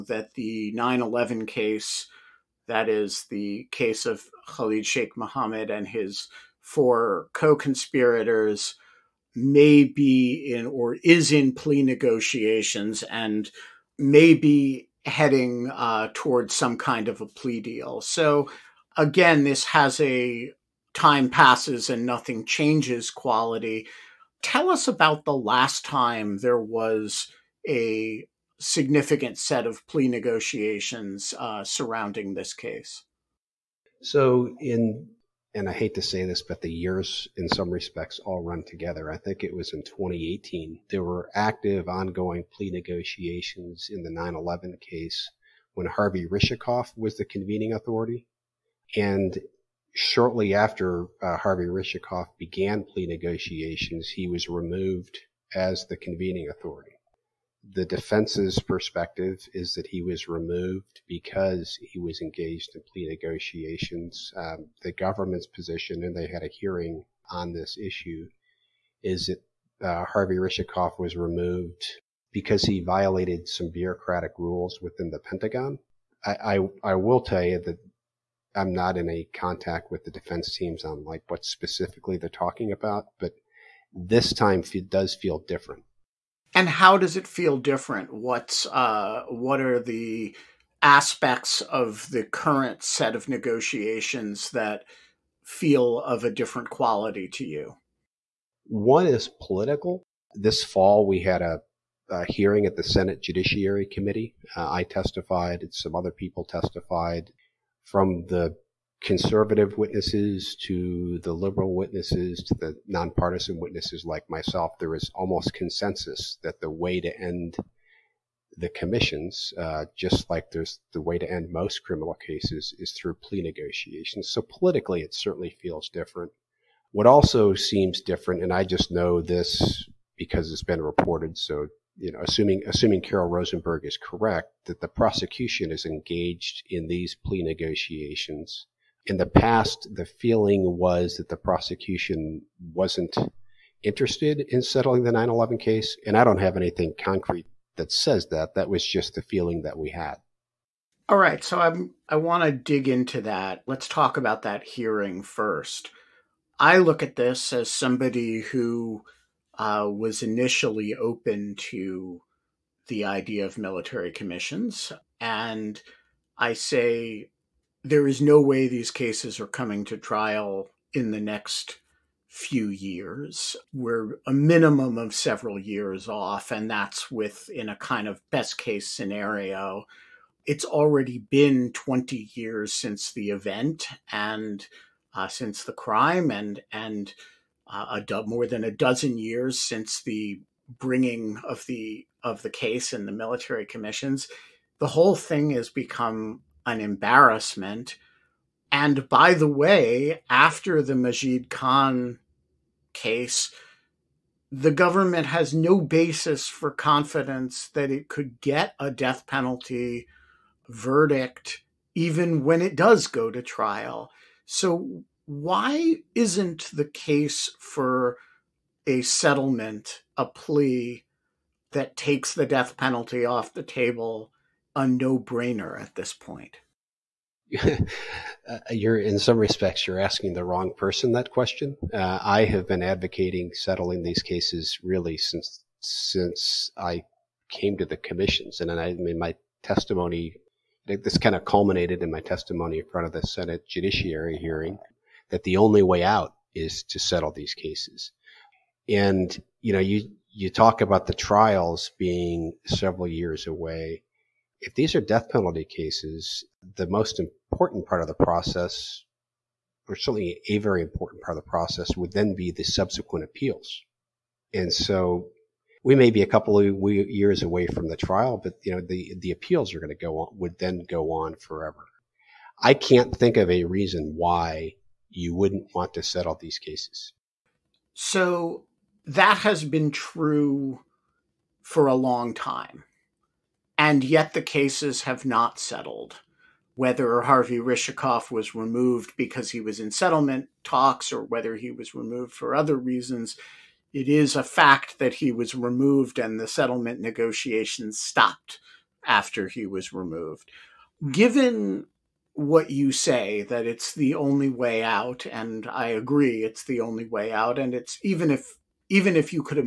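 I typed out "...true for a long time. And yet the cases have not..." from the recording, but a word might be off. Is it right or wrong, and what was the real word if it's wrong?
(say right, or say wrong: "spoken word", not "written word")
right.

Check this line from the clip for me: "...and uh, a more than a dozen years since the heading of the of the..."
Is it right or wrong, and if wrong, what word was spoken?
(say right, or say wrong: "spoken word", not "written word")
wrong: "bringing", not "heading".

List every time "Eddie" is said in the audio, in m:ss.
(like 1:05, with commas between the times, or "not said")
not said.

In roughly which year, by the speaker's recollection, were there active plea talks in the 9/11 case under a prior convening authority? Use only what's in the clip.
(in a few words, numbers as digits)
2018.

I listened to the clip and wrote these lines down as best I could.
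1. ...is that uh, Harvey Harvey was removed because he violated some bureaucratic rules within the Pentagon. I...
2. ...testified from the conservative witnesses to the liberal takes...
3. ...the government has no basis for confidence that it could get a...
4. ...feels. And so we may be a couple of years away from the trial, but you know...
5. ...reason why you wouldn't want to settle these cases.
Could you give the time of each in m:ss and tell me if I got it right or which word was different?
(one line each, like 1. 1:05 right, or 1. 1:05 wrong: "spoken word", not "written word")
1. 1:09 wrong: "Rishikoff", not "Harvey"
2. 1:46 wrong: "witnesses", not "takes"
3. 3:24 right
4. 4:23 wrong: "appeals", not "feels"
5. 4:33 right.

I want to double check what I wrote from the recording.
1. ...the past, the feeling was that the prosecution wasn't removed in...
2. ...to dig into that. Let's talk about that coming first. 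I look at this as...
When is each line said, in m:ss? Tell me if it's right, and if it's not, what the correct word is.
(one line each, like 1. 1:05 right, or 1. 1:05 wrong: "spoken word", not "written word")
1. 2:19 wrong: "interested", not "removed"
2. 2:32 wrong: "hearing", not "coming".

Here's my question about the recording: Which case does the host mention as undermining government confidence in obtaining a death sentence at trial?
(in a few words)
Majid Khan.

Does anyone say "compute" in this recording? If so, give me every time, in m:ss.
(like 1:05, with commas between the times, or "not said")
not said.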